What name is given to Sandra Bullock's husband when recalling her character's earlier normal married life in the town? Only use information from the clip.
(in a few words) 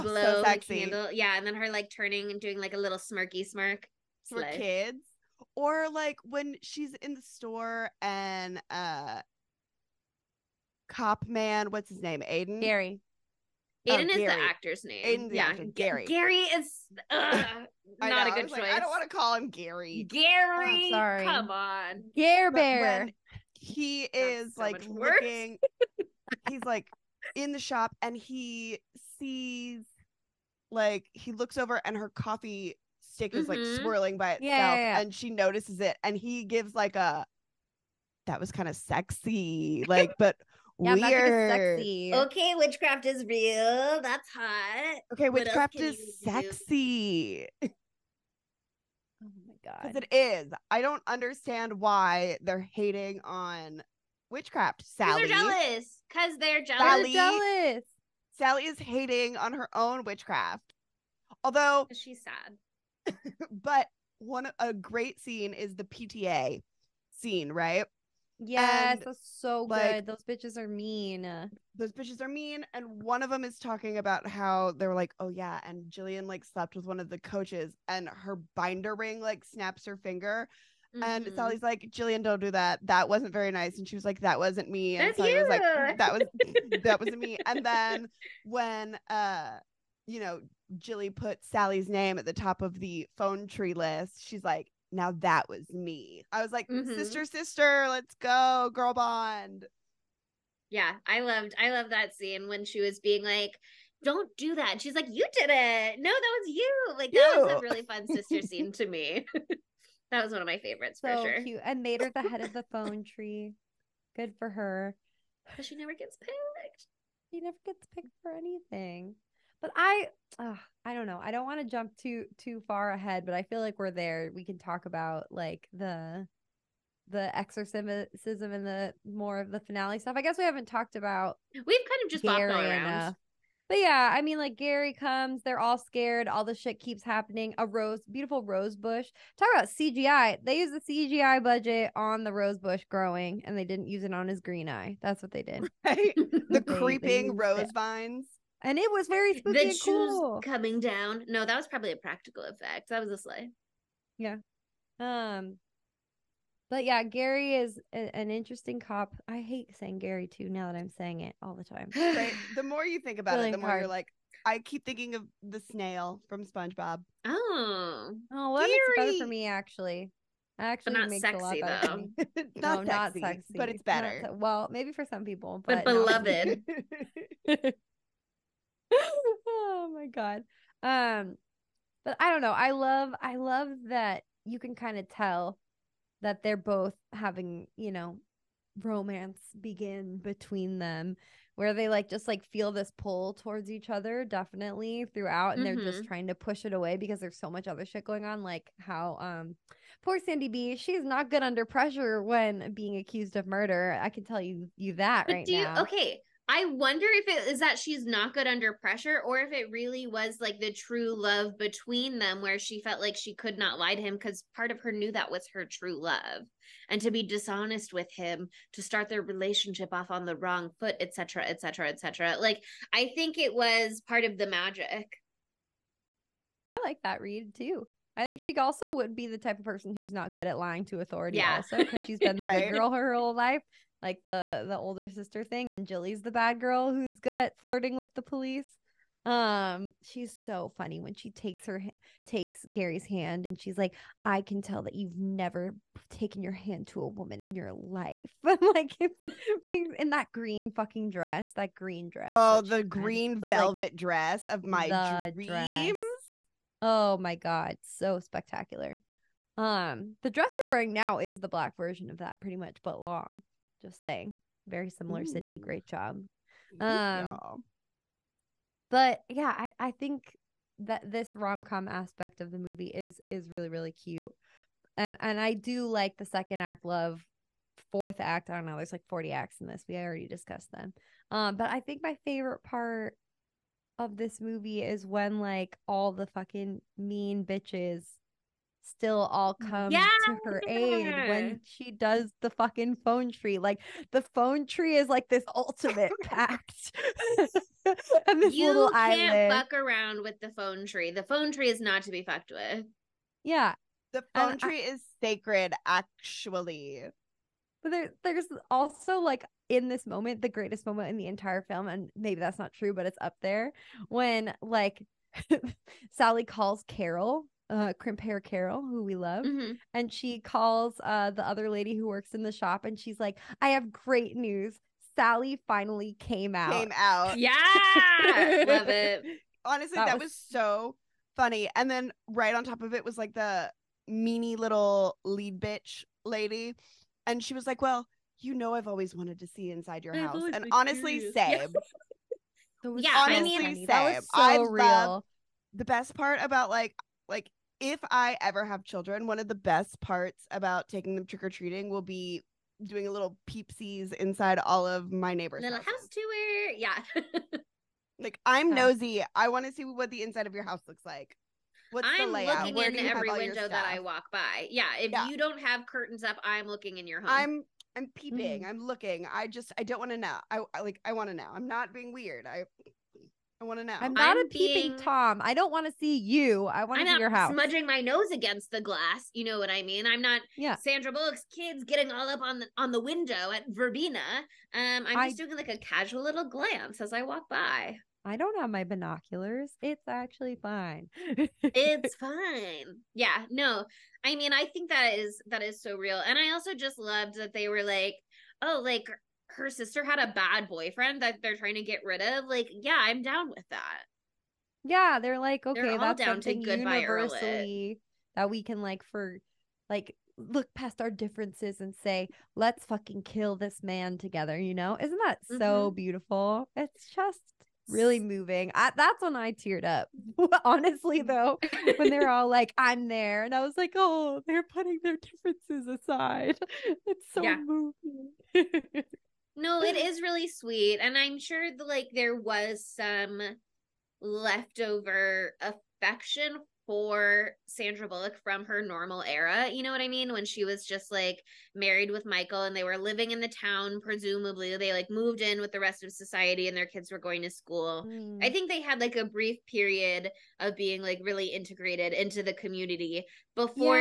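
Michael.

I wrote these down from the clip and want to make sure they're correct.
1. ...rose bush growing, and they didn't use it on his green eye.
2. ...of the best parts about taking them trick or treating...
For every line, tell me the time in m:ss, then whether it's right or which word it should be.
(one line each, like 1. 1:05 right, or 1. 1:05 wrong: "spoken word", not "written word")
1. 2:22 right
2. 5:49 right.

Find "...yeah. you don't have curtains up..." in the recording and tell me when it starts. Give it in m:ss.
6:05.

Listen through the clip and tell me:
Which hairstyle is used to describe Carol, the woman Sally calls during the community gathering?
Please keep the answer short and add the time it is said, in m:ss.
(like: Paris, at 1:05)
crimp hair, at 5:17.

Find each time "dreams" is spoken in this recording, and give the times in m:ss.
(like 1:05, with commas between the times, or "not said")
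4:15.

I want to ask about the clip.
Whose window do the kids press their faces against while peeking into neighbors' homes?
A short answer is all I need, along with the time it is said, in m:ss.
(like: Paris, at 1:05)
Verbena, at 6:23.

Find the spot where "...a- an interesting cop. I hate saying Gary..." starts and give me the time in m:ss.
2:37.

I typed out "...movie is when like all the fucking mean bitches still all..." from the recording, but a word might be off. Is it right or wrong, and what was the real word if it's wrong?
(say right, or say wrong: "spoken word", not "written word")
right.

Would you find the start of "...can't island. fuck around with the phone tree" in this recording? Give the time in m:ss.
4:58.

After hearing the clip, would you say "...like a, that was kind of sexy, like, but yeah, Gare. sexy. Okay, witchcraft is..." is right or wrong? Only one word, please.
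wrong.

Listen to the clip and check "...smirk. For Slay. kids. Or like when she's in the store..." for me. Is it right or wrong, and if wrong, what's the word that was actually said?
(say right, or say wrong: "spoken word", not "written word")
right.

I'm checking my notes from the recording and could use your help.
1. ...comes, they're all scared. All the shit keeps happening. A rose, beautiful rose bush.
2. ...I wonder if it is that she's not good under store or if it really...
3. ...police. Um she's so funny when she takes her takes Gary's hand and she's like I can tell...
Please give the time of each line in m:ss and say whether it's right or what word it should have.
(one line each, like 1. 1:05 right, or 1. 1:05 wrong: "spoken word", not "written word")
1. 2:14 right
2. 3:26 wrong: "pressure", not "store"
3. 3:58 right.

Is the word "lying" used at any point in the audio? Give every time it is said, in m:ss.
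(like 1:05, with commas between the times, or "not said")
3:50.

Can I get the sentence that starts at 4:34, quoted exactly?
And and I do like the second act love, fourth act.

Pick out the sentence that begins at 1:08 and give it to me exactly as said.
Yes, and, that's so like, good.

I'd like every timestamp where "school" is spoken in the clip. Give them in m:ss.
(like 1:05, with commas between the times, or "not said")
7:27.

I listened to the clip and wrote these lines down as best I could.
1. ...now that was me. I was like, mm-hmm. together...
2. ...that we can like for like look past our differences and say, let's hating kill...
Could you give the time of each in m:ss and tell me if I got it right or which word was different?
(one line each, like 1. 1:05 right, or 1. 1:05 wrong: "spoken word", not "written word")
1. 1:34 wrong: "sister", not "together"
2. 6:48 wrong: "fucking", not "hating".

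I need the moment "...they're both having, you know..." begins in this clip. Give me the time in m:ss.
3:06.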